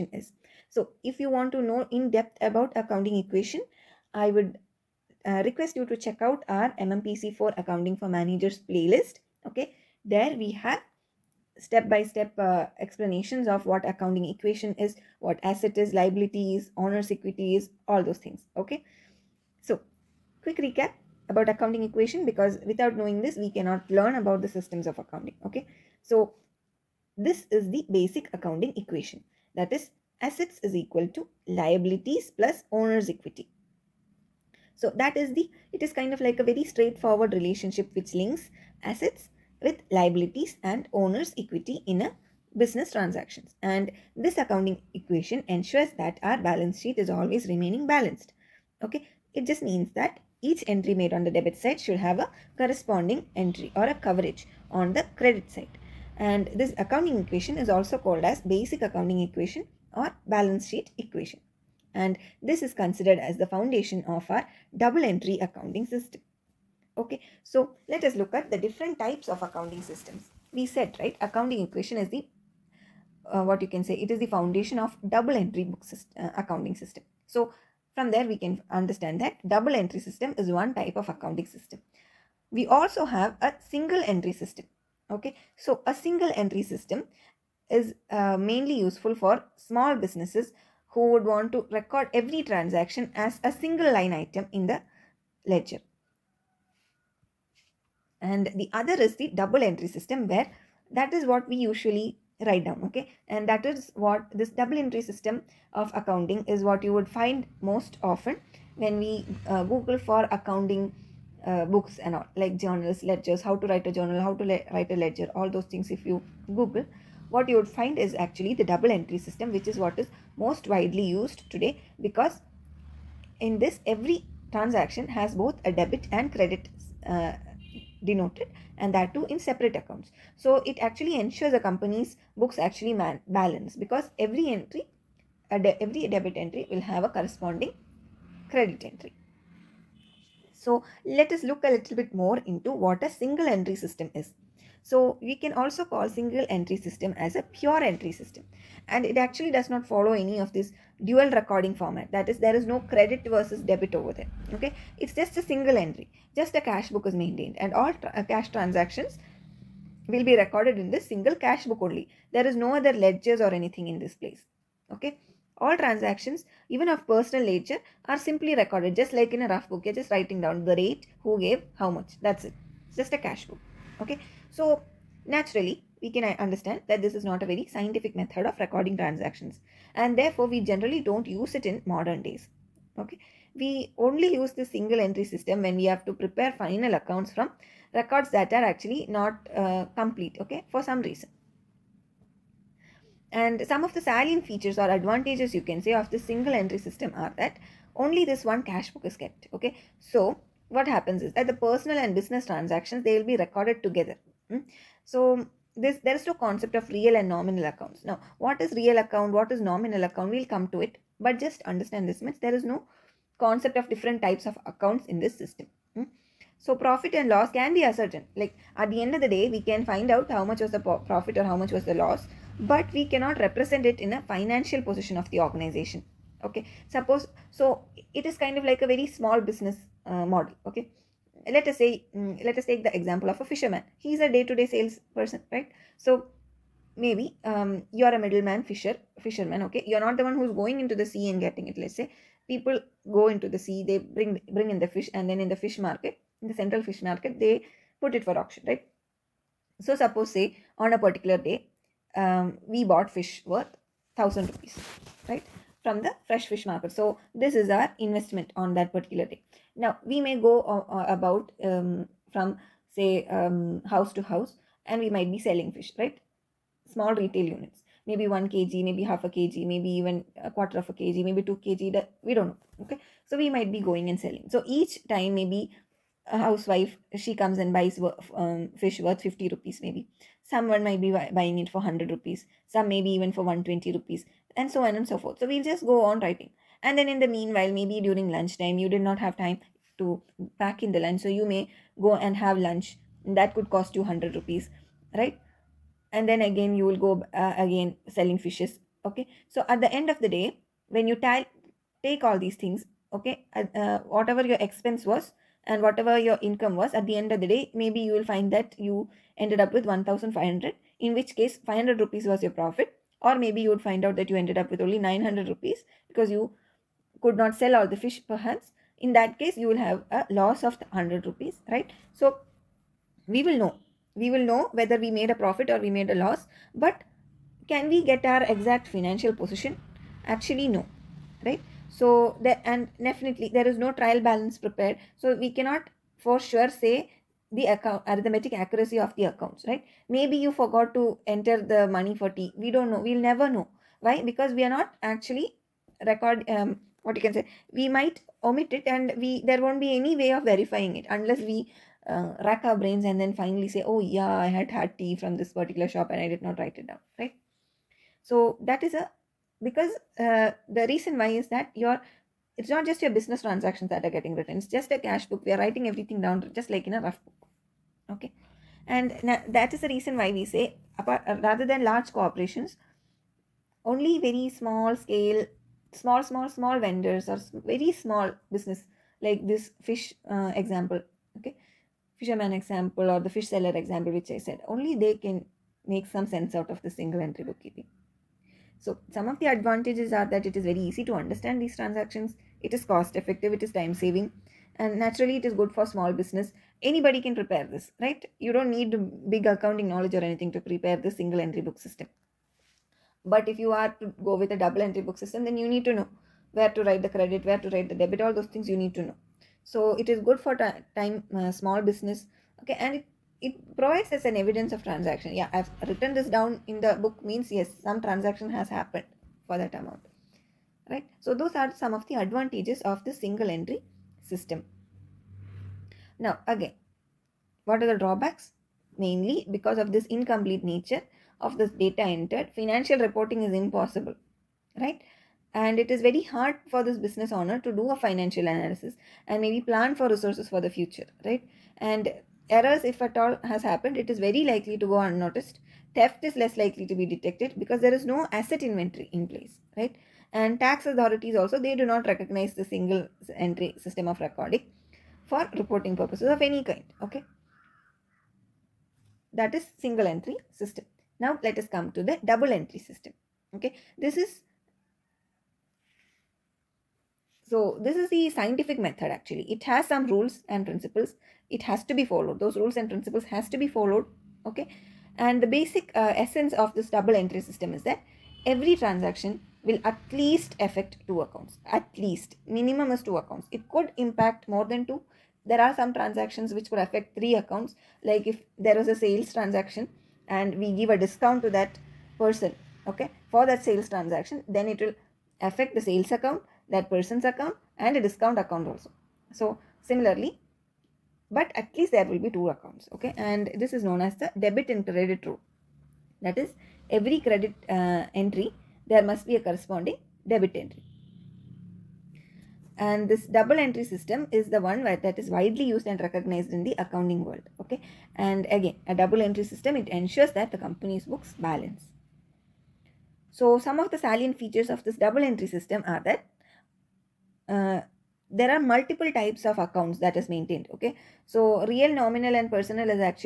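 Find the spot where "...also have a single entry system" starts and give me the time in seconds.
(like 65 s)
82 s.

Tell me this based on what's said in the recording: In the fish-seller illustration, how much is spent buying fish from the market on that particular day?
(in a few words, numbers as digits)
1000 rupees.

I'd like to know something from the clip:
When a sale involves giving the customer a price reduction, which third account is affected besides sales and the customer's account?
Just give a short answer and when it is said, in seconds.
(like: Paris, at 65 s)
Discount account, at 498 s.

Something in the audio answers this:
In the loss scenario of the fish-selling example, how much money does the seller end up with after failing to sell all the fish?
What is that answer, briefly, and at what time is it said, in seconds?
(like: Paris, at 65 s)
900 rupees, at 314 s.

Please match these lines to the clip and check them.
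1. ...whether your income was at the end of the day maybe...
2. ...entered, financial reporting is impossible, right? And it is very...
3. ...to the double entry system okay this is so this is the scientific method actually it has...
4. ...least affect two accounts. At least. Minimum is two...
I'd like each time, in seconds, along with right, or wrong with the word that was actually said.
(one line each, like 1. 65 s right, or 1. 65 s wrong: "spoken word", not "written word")
1. 305 s wrong: "whatever", not "whether"
2. 432 s right
3. 461 s right
4. 480 s right.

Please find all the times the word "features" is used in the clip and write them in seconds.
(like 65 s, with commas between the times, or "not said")
194 s, 524 s.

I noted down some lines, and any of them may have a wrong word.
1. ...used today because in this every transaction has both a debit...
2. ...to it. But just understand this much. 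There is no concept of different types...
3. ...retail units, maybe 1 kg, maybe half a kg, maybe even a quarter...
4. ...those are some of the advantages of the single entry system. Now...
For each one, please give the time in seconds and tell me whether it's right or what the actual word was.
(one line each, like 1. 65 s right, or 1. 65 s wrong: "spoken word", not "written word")
1. 121 s right
2. 210 s right
3. 267 s right
4. 421 s right.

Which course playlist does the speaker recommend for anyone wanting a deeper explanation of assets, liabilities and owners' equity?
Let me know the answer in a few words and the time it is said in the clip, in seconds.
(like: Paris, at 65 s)
MMPC for Accounting for Managers, at 6 s.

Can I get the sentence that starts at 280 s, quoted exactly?
Someone might be buying it for 100 rupees, some maybe even for 120 rupees, and so on and so forth.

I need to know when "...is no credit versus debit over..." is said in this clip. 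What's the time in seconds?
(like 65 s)
152 s.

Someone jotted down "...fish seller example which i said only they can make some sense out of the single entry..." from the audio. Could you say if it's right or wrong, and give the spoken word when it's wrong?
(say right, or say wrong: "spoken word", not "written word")
right.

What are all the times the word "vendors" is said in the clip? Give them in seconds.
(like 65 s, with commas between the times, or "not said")
376 s.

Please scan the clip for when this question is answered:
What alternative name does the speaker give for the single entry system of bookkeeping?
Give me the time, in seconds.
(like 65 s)
147 s.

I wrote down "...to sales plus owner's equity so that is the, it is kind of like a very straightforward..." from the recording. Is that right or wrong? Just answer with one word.
wrong.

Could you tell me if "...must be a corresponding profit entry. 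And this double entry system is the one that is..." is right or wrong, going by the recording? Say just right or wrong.
wrong.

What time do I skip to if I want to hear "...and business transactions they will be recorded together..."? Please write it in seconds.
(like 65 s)
201 s.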